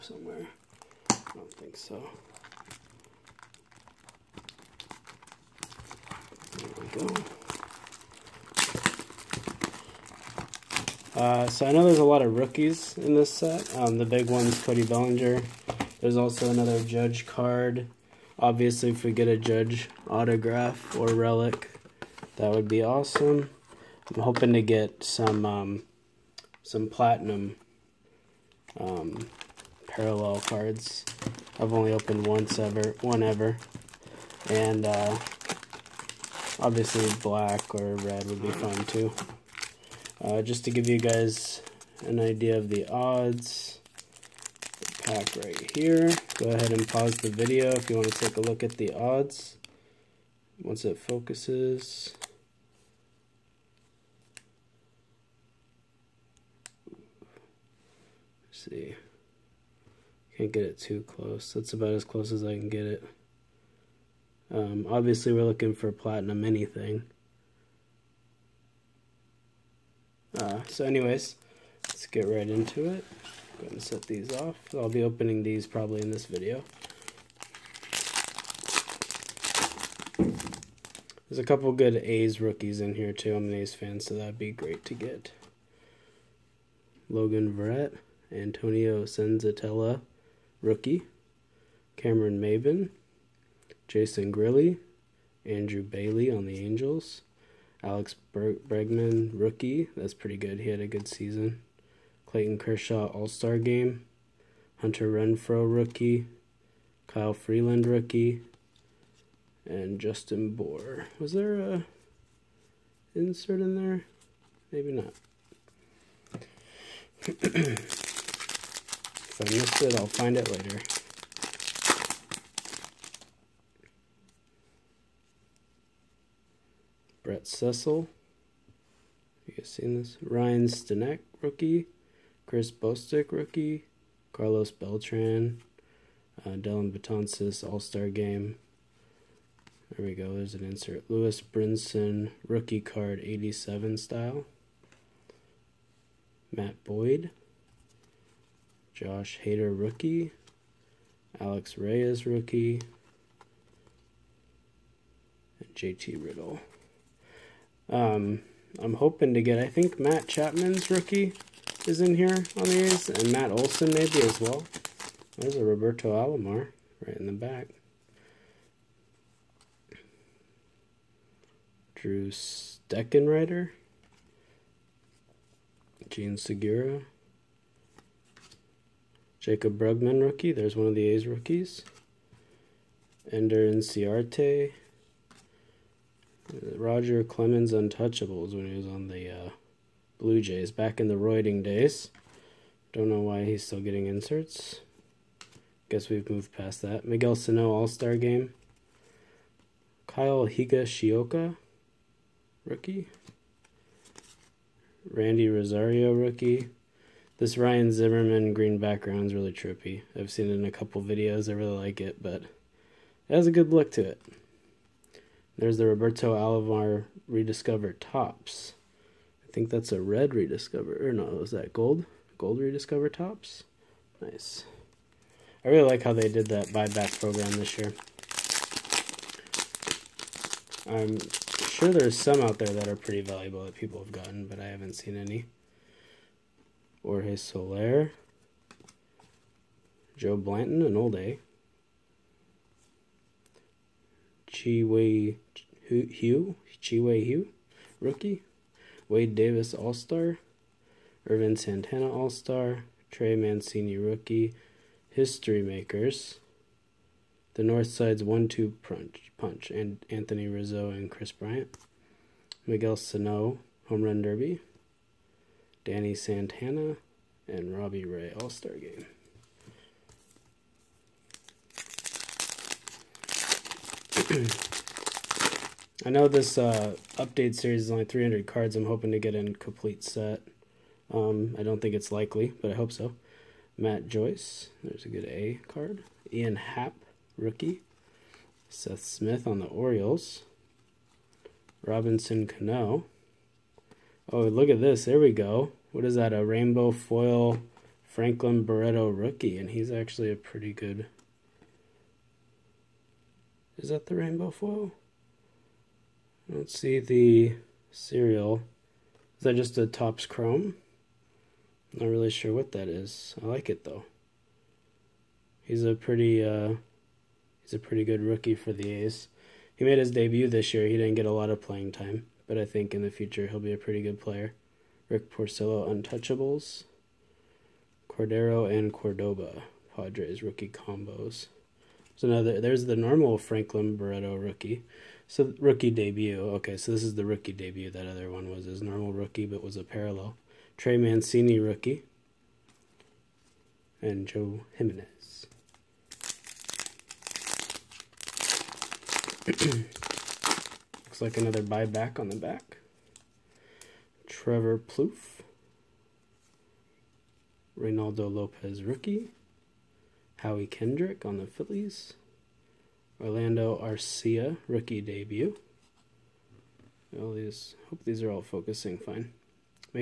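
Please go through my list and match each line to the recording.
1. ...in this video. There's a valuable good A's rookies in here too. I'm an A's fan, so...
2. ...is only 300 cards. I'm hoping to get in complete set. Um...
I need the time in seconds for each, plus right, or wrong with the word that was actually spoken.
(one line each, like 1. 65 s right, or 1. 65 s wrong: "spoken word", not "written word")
1. 76 s wrong: "couple", not "valuable"
2. 277 s right.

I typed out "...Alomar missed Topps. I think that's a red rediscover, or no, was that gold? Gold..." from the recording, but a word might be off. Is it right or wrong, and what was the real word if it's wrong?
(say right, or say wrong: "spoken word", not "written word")
wrong: "rediscovered", not "missed".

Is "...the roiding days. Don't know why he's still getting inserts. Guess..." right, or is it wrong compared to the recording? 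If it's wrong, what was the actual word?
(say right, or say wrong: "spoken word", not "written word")
right.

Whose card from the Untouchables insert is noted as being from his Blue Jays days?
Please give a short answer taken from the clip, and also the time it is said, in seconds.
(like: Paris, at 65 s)
Roger Clemens, at 186 s.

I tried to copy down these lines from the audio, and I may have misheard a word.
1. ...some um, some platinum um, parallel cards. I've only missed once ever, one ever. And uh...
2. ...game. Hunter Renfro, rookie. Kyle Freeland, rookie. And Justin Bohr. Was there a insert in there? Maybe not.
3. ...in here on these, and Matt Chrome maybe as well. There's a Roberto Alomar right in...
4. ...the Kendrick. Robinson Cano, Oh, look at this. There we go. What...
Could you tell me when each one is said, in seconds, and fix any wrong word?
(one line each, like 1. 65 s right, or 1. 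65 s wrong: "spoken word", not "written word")
1. 25 s wrong: "opened", not "missed"
2. 103 s right
3. 162 s wrong: "Olson", not "Chrome"
4. 289 s wrong: "Orioles", not "Kendrick".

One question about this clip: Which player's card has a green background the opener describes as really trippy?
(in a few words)
Ryan Zimmerman.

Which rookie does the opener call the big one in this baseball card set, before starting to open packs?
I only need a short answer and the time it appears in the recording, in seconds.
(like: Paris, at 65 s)
Cody Bellinger, at 14 s.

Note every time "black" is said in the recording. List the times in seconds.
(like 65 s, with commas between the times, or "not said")
37 s.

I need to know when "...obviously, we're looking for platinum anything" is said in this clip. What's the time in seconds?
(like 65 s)
64 s.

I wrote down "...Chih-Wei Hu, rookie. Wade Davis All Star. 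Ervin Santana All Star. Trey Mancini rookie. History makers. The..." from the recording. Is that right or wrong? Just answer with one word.
right.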